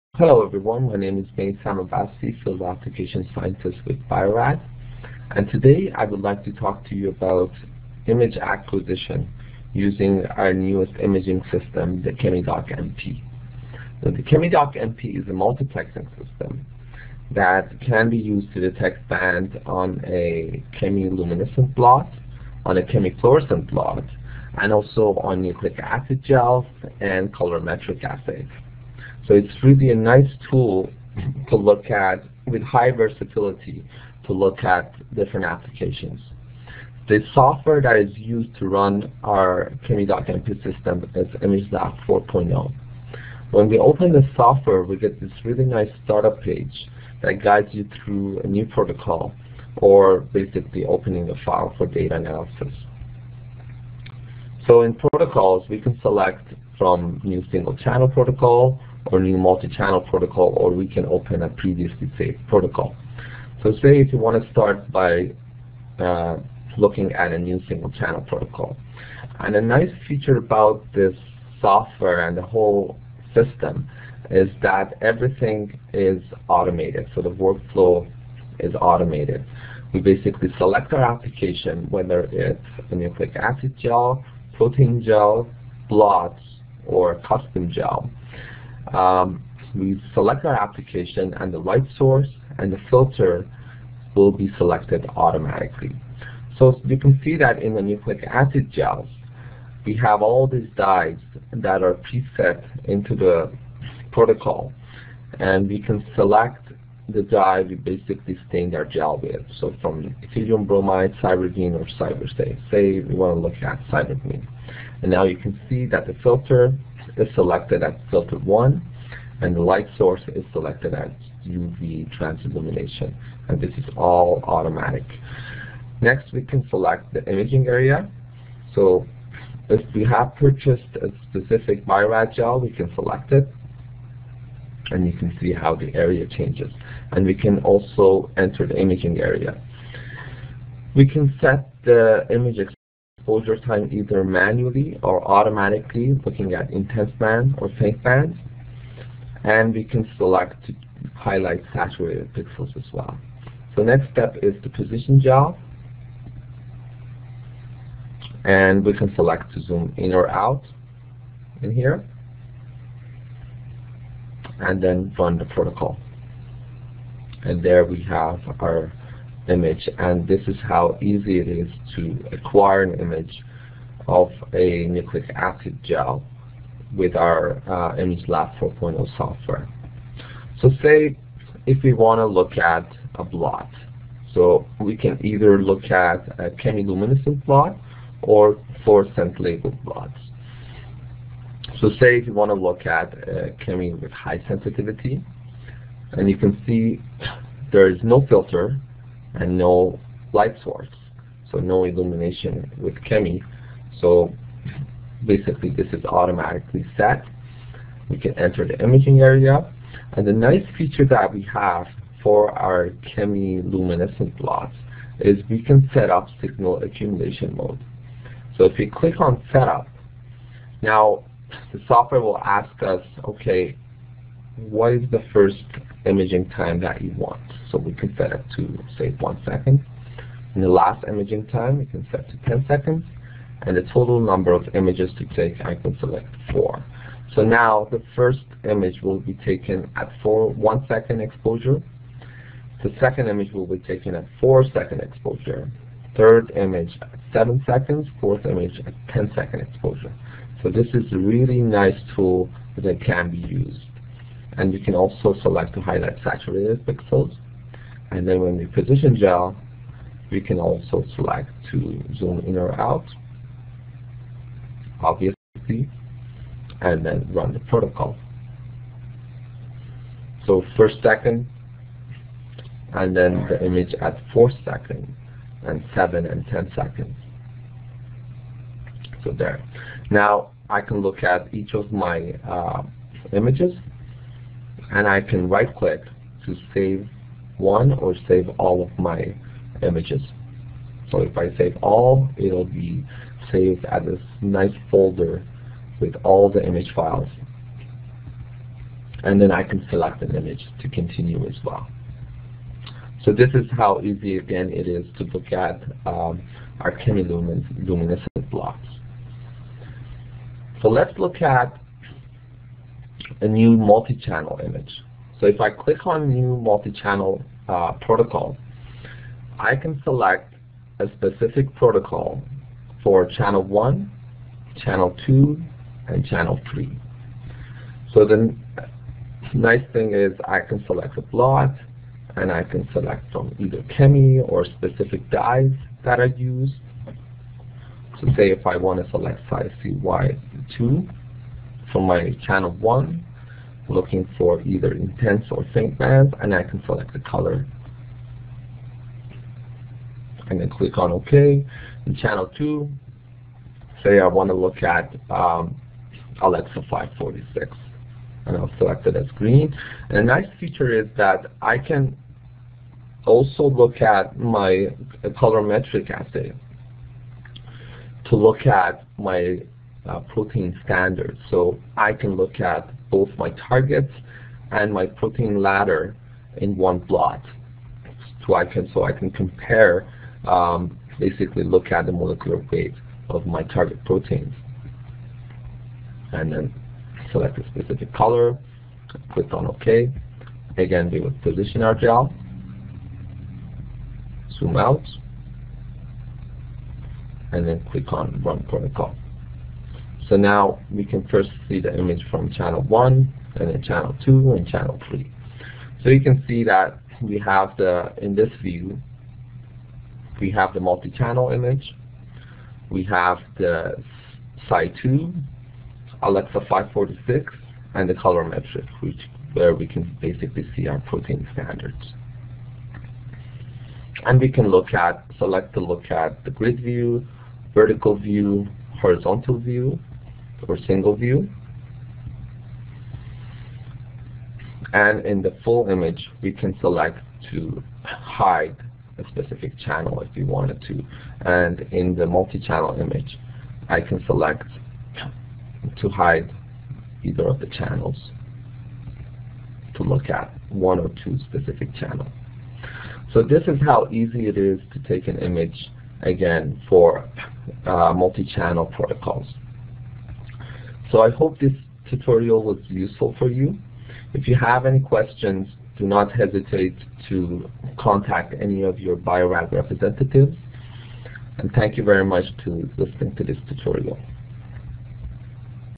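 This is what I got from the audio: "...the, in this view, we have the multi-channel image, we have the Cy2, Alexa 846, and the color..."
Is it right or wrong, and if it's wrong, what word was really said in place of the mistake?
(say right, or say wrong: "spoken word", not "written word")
wrong: "546", not "846".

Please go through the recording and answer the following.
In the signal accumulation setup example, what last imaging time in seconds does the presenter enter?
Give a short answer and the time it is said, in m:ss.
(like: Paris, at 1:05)
10 seconds, at 3:52.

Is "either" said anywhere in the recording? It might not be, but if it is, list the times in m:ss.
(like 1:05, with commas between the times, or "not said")
2:23, 3:05, 5:33, 5:44, 7:27.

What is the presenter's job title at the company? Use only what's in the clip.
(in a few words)
Field Application Scientist.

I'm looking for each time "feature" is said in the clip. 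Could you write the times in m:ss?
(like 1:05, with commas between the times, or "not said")
1:10, 3:30, 6:00.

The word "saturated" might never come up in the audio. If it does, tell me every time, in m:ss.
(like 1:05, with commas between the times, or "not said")
2:31, 4:16.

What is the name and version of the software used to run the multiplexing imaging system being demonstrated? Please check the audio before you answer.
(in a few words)
ImageLab 4.0.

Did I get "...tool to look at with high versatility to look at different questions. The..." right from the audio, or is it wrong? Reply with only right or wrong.
wrong.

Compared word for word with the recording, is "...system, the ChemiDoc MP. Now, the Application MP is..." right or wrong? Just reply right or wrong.
wrong.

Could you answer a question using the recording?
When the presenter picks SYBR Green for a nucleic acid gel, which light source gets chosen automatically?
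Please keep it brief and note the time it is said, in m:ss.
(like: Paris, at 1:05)
UV transillumination, at 2:01.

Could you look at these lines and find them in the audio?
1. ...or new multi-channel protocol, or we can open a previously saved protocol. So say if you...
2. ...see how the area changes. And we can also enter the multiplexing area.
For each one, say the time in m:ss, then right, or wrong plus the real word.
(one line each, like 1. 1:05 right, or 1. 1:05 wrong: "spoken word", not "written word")
1. 0:59 right
2. 2:15 wrong: "imaging", not "multiplexing".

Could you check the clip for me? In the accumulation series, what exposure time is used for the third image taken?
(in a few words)
7 seconds.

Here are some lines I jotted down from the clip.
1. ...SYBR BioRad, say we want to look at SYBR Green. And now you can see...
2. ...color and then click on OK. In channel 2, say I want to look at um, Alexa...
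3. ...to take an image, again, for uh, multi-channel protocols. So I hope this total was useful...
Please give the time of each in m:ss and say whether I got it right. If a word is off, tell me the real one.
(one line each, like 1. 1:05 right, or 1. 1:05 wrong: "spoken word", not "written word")
1. 1:51 wrong: "Safe", not "BioRad"
2. 5:47 right
3. 7:34 wrong: "tutorial", not "total".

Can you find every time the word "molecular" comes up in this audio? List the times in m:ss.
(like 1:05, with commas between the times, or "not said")
6:22.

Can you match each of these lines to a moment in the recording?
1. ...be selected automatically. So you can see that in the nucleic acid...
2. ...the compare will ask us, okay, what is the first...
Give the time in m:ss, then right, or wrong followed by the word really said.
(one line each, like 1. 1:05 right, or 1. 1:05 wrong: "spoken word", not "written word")
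1. 1:34 right
2. 3:41 wrong: "software", not "compare".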